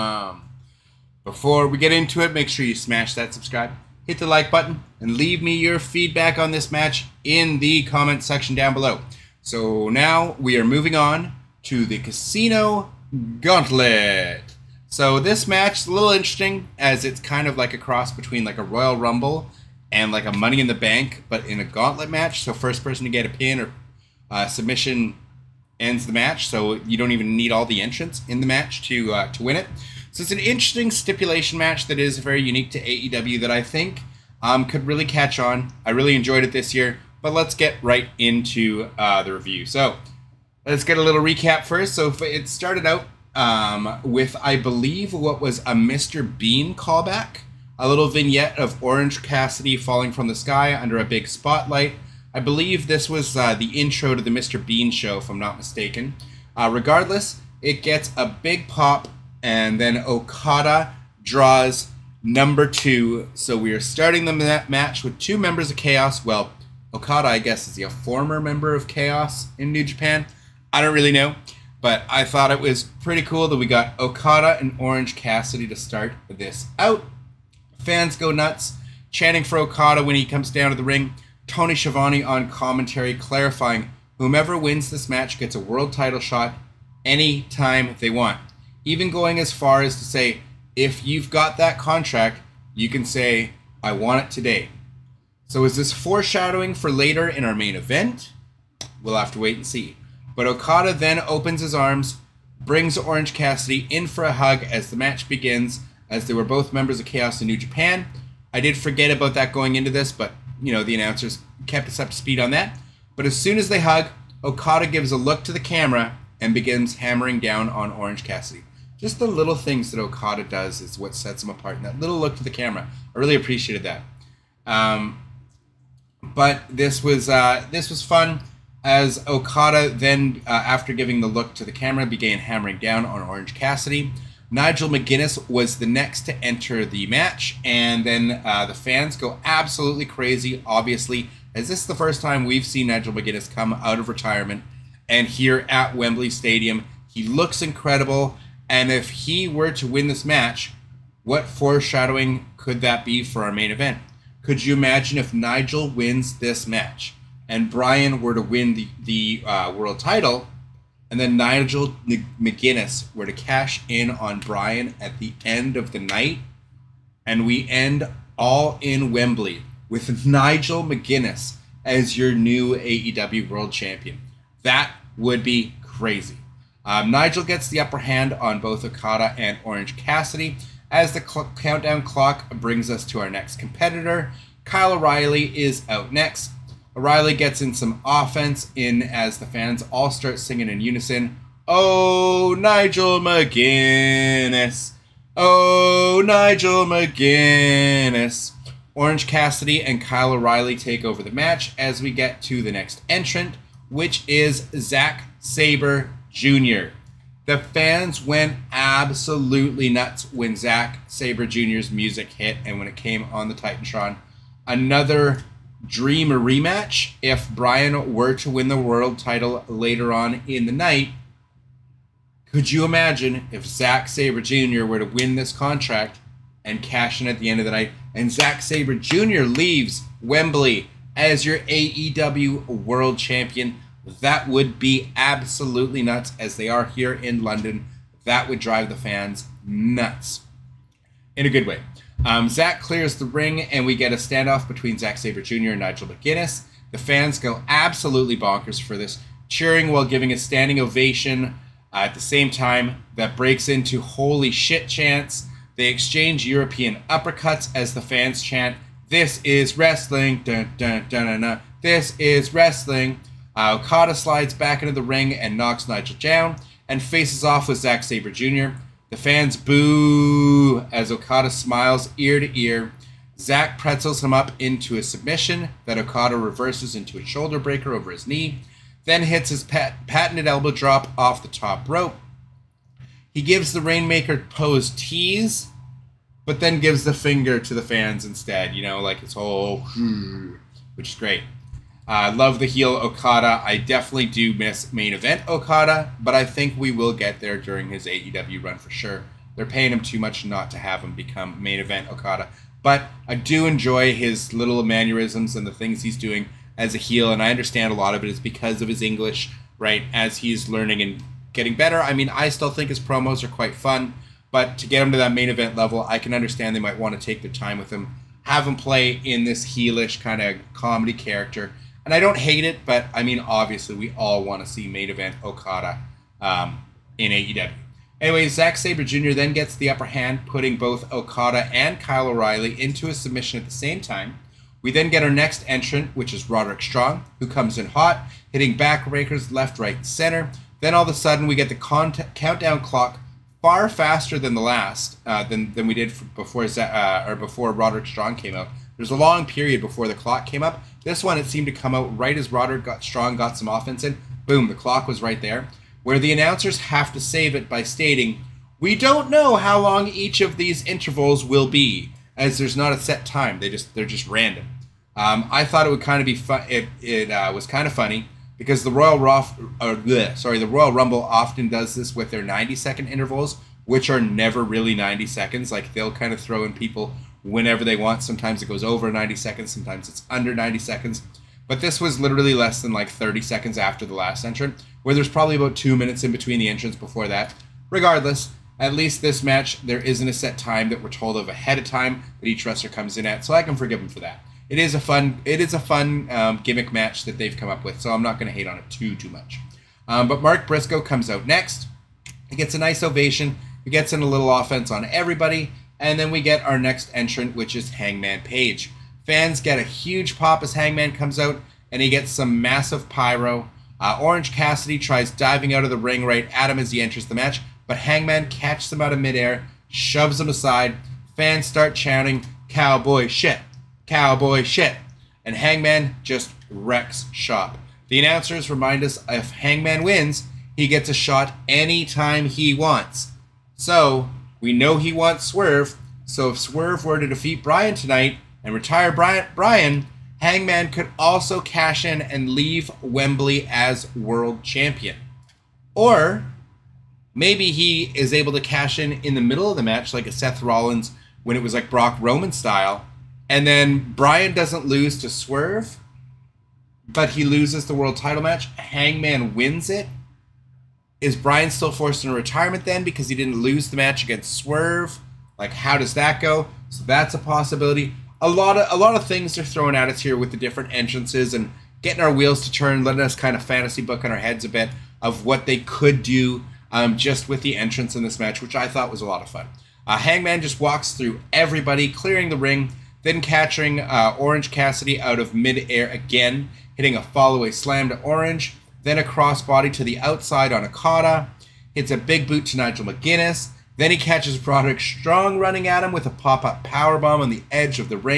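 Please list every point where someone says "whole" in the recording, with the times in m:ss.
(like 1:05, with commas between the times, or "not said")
4:49.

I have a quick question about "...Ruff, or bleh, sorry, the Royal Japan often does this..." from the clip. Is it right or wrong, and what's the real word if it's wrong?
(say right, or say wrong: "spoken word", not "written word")
wrong: "Rumble", not "Japan".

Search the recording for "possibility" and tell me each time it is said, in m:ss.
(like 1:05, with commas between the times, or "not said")
7:47.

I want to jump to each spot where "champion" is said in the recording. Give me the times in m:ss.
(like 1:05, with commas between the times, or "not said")
2:53, 3:53, 7:24.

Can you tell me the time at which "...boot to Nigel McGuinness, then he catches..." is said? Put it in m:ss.
8:12.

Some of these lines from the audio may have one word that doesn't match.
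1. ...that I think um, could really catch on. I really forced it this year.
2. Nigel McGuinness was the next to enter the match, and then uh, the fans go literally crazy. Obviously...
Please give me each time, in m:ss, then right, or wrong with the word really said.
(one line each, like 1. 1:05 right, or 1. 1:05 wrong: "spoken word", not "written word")
1. 0:33 wrong: "enjoyed", not "forced"
2. 2:14 wrong: "absolutely", not "literally".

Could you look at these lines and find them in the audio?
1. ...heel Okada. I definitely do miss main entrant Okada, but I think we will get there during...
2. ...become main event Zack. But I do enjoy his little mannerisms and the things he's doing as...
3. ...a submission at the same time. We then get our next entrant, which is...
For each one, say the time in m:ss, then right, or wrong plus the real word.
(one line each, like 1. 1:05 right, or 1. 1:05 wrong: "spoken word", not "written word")
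1. 4:52 wrong: "event", not "entrant"
2. 5:01 wrong: "Okada", not "Zack"
3. 5:33 right.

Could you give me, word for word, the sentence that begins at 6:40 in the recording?
Um, but Mark Briscoe comes out next.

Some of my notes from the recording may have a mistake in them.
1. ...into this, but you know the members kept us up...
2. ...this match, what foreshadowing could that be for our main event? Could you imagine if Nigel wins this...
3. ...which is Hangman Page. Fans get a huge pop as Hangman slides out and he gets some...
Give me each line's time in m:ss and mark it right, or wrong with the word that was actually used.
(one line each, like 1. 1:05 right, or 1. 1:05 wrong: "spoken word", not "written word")
1. 1:49 wrong: "announcers", not "members"
2. 2:30 right
3. 6:47 wrong: "comes", not "slides".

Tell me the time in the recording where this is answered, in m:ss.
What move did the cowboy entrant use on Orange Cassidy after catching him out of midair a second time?
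8:07.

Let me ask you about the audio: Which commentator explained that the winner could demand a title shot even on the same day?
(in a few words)
Tony Schiavone.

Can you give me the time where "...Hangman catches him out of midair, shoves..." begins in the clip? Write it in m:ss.
6:57.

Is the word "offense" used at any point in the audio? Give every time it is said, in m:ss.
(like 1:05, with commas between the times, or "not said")
3:08, 5:53, 6:44.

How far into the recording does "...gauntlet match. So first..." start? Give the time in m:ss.
0:21.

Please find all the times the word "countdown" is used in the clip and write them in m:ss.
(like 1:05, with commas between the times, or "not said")
3:01, 5:42.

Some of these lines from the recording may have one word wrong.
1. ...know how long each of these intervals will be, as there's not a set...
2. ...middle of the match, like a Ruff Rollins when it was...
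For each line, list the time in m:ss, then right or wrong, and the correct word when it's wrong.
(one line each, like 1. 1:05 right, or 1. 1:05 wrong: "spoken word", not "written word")
1. 5:59 right
2. 7:29 wrong: "Seth", not "Ruff".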